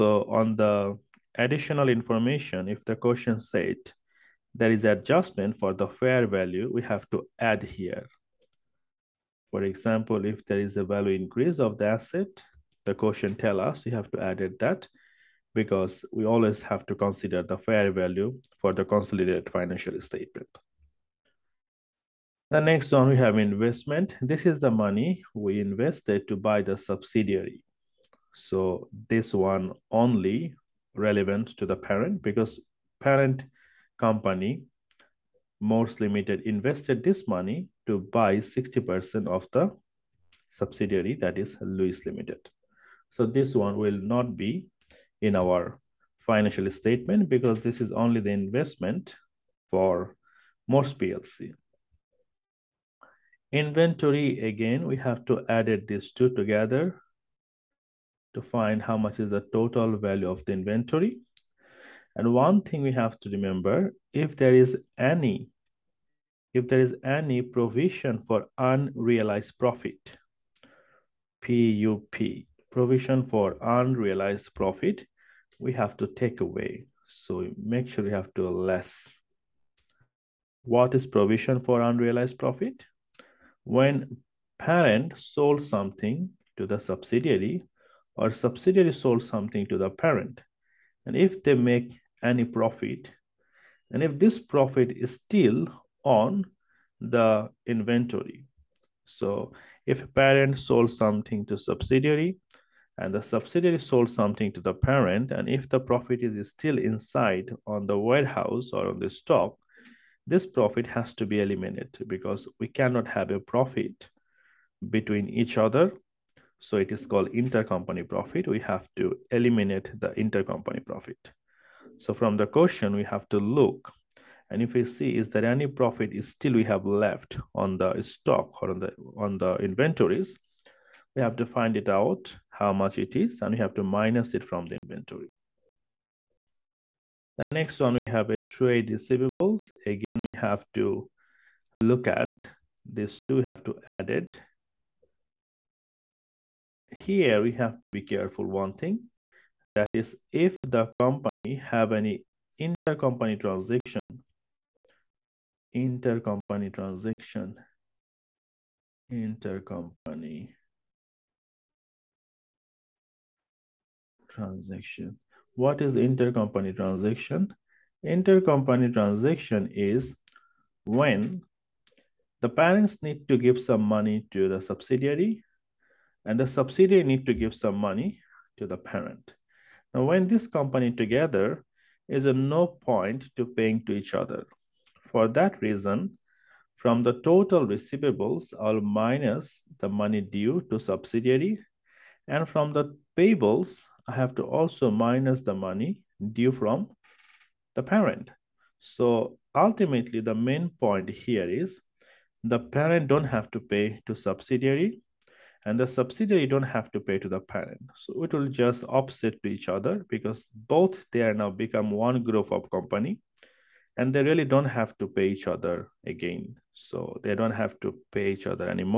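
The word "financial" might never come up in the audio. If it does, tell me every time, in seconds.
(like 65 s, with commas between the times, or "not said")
19 s, 46 s.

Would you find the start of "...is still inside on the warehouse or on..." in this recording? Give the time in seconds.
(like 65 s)
106 s.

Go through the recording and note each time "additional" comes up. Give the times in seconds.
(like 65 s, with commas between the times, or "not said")
1 s.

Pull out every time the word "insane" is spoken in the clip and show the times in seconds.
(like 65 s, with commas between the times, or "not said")
not said.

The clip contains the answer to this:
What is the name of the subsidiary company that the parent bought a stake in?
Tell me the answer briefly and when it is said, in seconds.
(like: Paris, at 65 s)
Lewis Limited, at 41 s.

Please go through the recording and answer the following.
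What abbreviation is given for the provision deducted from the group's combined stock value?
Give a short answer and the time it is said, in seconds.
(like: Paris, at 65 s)
PUP, at 71 s.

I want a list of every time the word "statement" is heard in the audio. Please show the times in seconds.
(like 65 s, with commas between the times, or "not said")
20 s, 46 s.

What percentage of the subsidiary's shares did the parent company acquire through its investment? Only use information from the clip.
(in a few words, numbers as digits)
60%.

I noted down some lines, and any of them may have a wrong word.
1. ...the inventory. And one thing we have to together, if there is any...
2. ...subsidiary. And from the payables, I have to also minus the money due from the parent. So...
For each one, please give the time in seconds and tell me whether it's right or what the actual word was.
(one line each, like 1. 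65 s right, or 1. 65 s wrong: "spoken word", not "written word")
1. 60 s wrong: "remember", not "together"
2. 190 s right.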